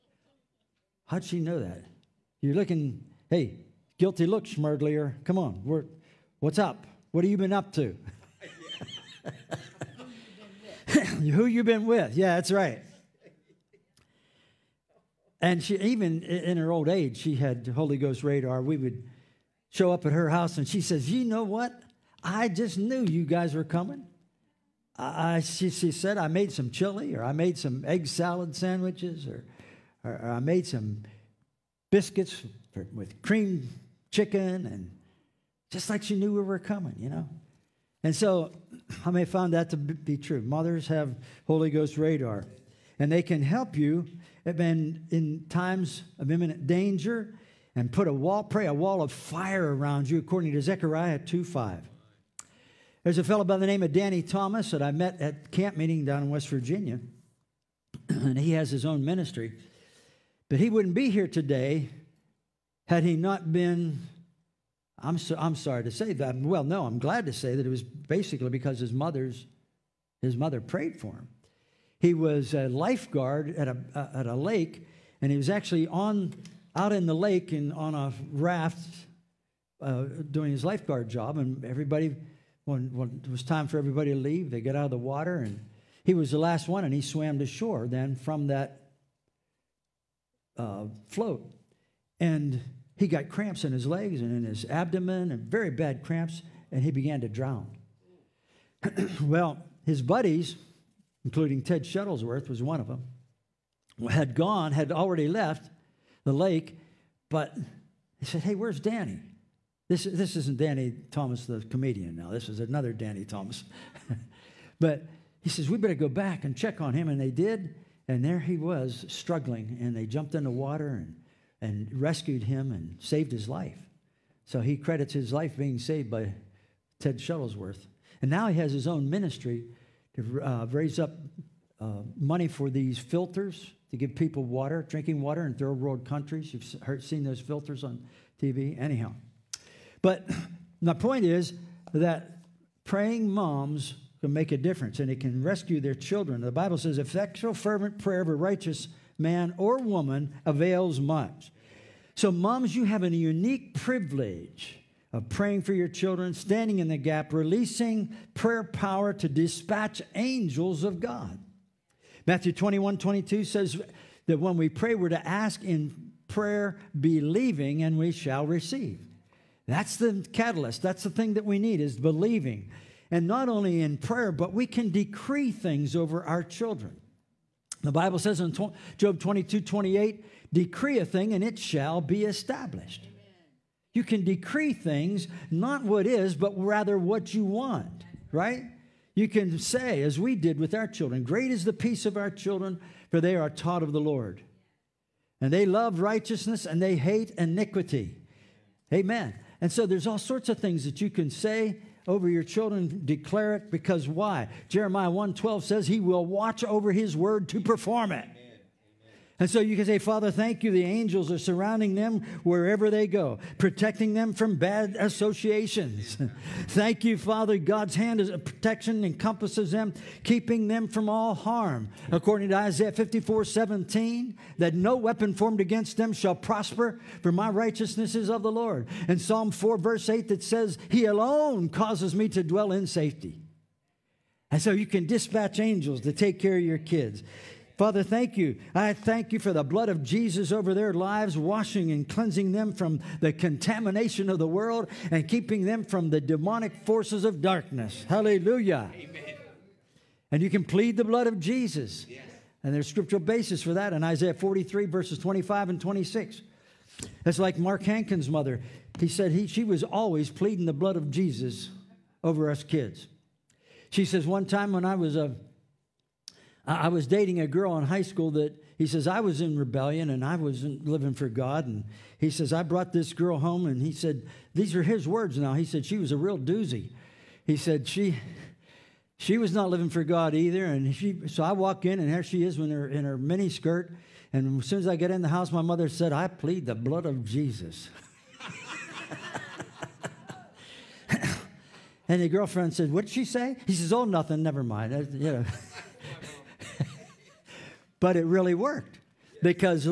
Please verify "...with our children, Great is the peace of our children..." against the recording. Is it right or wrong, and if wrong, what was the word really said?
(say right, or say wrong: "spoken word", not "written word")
right.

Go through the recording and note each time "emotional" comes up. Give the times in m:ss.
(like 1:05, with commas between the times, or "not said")
not said.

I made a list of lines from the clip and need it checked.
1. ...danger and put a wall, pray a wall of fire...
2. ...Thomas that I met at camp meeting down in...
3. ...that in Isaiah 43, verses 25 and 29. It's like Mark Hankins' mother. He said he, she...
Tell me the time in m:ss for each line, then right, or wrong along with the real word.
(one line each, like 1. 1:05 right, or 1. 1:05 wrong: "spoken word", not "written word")
1. 0:46 right
2. 0:54 right
3. 4:13 wrong: "26", not "29".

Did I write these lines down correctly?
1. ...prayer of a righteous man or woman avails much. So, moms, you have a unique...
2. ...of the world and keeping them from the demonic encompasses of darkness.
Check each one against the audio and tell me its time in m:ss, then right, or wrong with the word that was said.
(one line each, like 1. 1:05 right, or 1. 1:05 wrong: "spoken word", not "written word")
1. 2:27 right
2. 4:04 wrong: "forces", not "encompasses".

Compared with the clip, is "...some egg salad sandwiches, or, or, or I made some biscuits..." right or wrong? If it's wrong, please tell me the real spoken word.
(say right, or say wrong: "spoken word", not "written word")
right.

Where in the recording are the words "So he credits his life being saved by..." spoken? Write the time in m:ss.
2:04.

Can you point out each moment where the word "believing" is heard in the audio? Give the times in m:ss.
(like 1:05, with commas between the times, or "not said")
2:46, 2:51.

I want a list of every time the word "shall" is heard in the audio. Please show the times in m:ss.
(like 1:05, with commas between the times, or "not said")
2:48, 3:01, 3:46.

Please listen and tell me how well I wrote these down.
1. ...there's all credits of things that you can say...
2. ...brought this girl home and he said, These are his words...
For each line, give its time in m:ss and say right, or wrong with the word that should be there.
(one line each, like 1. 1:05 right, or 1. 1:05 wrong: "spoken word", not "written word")
1. 3:19 wrong: "sorts", not "credits"
2. 4:32 right.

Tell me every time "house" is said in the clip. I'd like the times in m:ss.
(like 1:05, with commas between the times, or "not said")
0:20, 4:45.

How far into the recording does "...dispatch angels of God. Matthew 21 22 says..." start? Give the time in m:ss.
2:39.